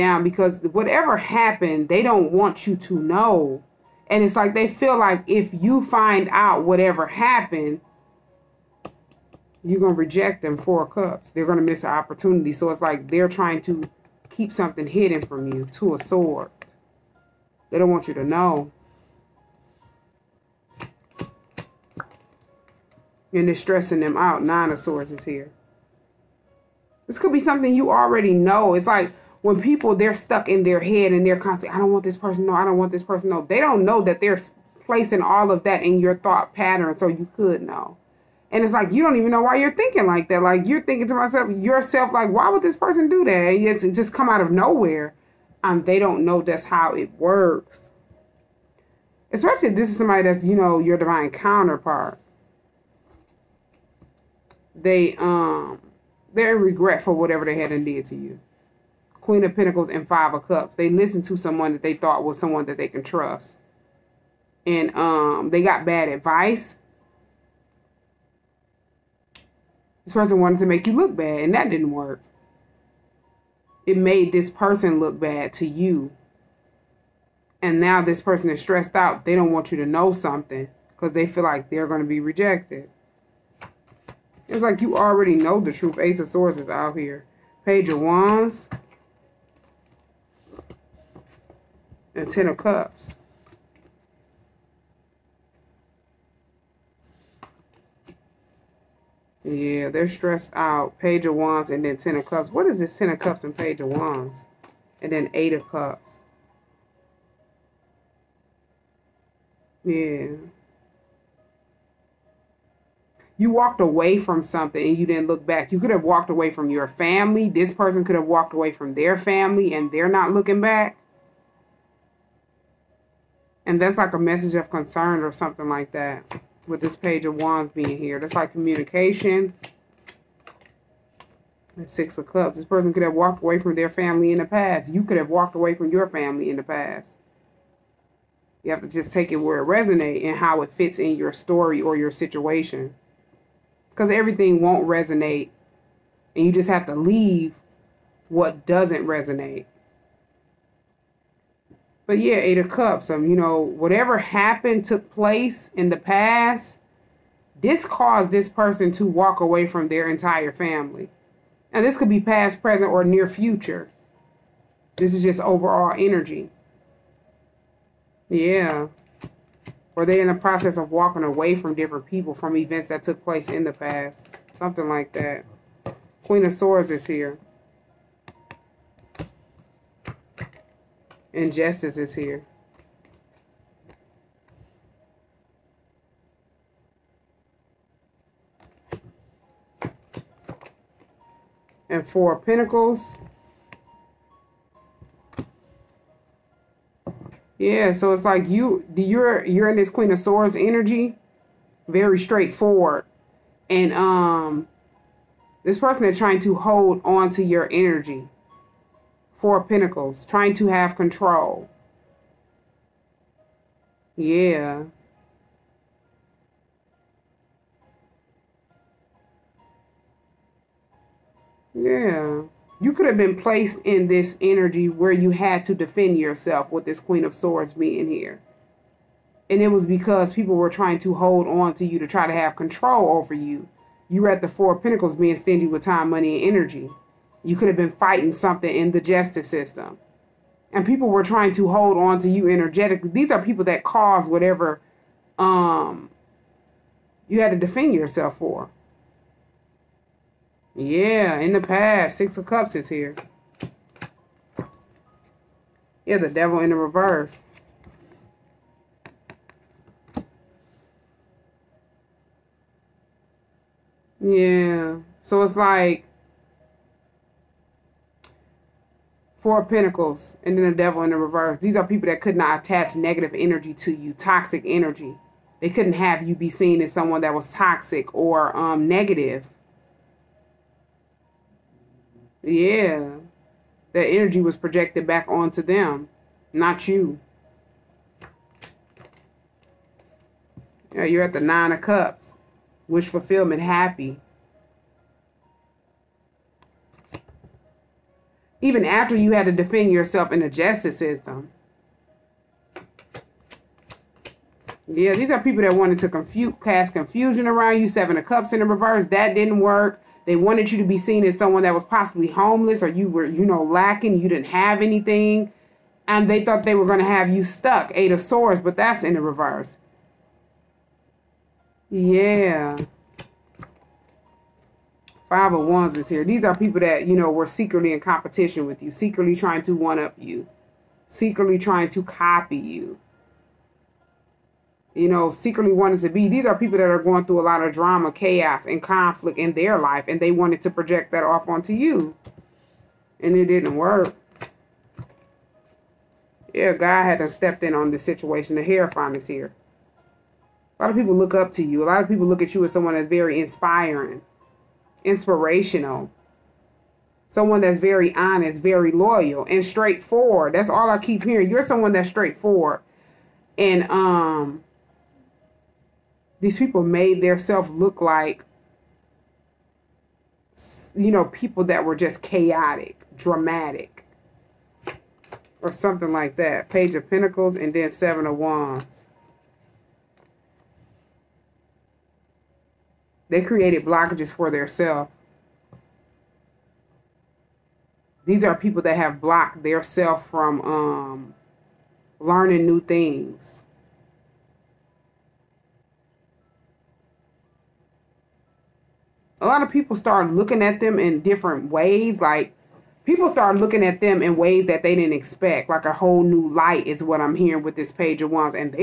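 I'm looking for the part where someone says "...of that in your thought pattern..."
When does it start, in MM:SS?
00:35.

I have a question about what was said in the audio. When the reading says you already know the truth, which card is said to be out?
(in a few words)
Ace of Swords.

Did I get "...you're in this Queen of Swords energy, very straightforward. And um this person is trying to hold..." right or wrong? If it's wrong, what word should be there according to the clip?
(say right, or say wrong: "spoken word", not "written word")
right.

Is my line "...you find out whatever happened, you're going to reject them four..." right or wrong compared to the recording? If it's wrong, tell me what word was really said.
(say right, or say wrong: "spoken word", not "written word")
right.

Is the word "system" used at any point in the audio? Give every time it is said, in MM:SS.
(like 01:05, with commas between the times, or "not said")
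03:59, 05:00.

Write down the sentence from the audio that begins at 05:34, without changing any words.
You know, secretly wanted to be.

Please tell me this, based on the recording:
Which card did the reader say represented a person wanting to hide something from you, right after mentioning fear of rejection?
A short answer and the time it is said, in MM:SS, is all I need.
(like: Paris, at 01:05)
Two of Swords, at 00:15.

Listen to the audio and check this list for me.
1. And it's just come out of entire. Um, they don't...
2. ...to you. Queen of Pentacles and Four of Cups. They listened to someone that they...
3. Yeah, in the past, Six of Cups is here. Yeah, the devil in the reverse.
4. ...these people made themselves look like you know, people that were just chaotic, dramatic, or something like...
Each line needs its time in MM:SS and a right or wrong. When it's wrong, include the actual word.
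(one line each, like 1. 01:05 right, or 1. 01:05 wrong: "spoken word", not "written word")
1. 00:43 wrong: "nowhere", not "entire"
2. 00:58 wrong: "Five", not "Four"
3. 04:10 right
4. 06:06 right.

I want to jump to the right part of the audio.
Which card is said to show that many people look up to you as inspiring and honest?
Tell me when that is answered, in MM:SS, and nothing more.
05:48.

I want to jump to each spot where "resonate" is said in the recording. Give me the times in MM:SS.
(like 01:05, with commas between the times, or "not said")
02:19, 02:24, 02:29.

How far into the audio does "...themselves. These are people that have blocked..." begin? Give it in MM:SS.
06:24.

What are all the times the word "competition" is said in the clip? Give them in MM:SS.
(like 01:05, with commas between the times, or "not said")
05:27.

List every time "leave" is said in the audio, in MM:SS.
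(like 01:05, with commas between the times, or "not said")
02:26.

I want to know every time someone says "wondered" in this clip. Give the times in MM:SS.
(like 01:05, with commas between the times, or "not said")
not said.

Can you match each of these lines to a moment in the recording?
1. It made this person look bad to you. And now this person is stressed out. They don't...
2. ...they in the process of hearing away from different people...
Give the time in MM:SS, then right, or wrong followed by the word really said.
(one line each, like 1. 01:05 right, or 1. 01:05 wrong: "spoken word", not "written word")
1. 01:13 right
2. 02:50 wrong: "walking", not "hearing".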